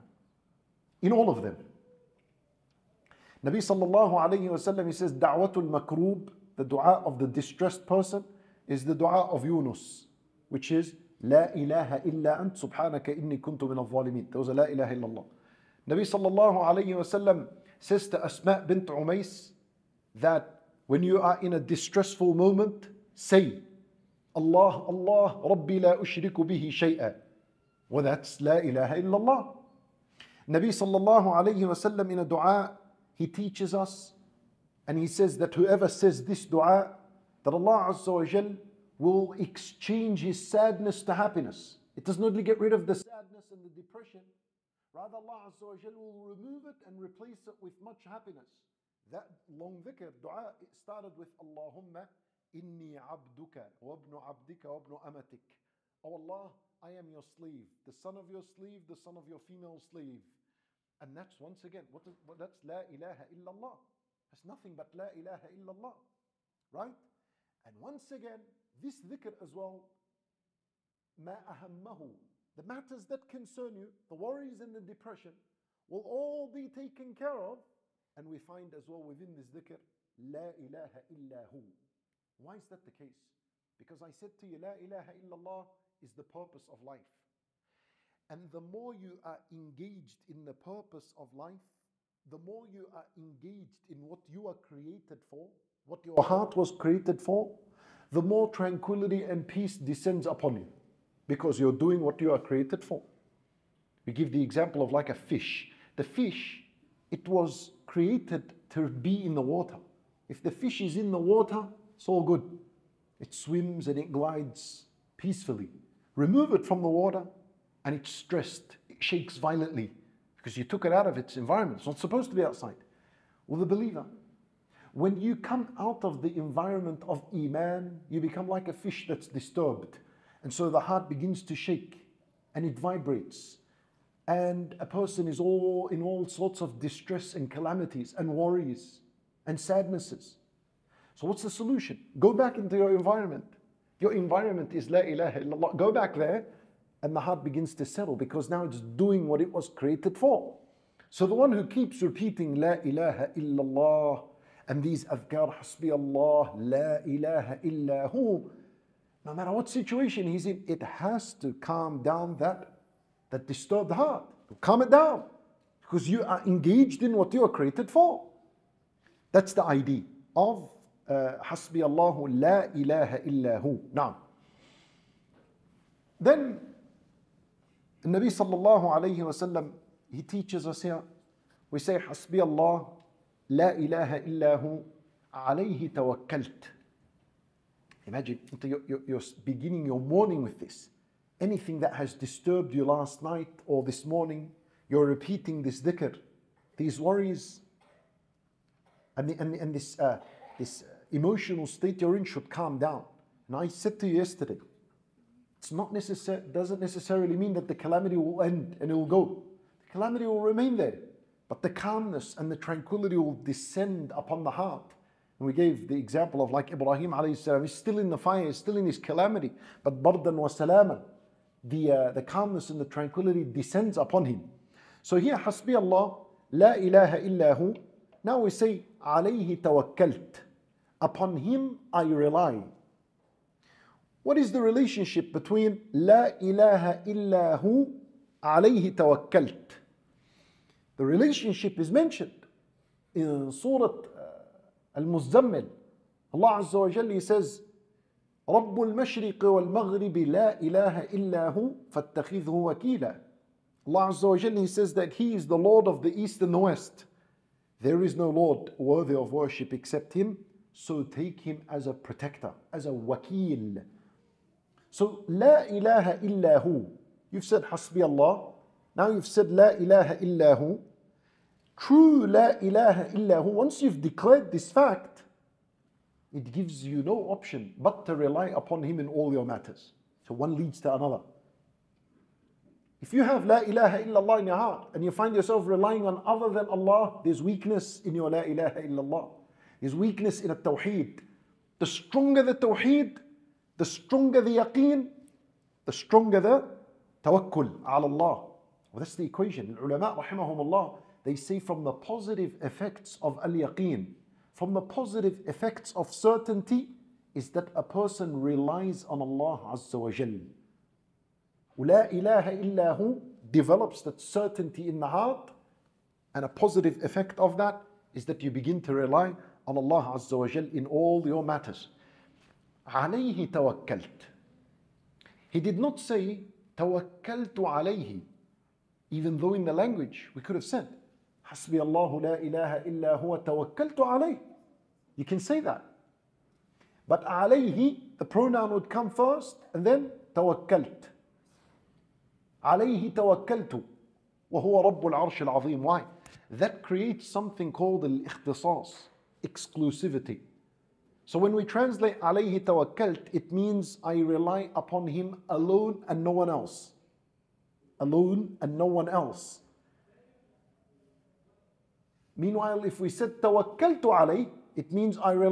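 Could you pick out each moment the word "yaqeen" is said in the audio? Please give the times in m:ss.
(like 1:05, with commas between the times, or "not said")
4:54, 5:03.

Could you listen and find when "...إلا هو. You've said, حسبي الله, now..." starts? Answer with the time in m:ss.
4:26.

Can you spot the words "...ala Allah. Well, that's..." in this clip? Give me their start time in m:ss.
4:57.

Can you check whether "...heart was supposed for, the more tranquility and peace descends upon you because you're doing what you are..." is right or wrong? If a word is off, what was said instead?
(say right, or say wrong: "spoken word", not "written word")
wrong: "created", not "supposed".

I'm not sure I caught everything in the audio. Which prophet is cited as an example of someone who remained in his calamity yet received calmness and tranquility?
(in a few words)
Ibrahim.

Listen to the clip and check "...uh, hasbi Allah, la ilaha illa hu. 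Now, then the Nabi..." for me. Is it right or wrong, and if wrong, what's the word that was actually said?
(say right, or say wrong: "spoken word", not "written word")
right.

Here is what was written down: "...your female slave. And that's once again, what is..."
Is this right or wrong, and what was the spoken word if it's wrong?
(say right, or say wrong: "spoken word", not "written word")
right.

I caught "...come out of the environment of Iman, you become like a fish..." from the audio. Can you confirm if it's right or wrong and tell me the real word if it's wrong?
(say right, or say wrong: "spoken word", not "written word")
right.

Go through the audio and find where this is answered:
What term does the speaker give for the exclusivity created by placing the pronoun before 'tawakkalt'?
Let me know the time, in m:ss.
5:48.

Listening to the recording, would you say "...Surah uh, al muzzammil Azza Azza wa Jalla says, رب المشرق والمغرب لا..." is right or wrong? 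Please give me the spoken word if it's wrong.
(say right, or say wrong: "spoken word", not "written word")
wrong: "Allah", not "Azza".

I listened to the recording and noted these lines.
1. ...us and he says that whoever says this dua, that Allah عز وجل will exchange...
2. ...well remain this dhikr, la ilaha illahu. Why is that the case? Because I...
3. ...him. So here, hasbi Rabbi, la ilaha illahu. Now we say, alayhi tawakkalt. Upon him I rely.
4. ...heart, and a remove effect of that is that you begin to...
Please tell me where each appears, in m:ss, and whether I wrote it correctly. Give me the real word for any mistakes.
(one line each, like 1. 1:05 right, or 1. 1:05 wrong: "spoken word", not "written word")
1. 0:33 right
2. 1:18 wrong: "within", not "remain"
3. 3:44 wrong: "Allah", not "Rabbi"
4. 5:15 wrong: "positive", not "remove".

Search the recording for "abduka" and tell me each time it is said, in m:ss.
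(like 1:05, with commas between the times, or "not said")
0:52.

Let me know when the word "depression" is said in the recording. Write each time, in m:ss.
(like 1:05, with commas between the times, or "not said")
0:43, 1:14.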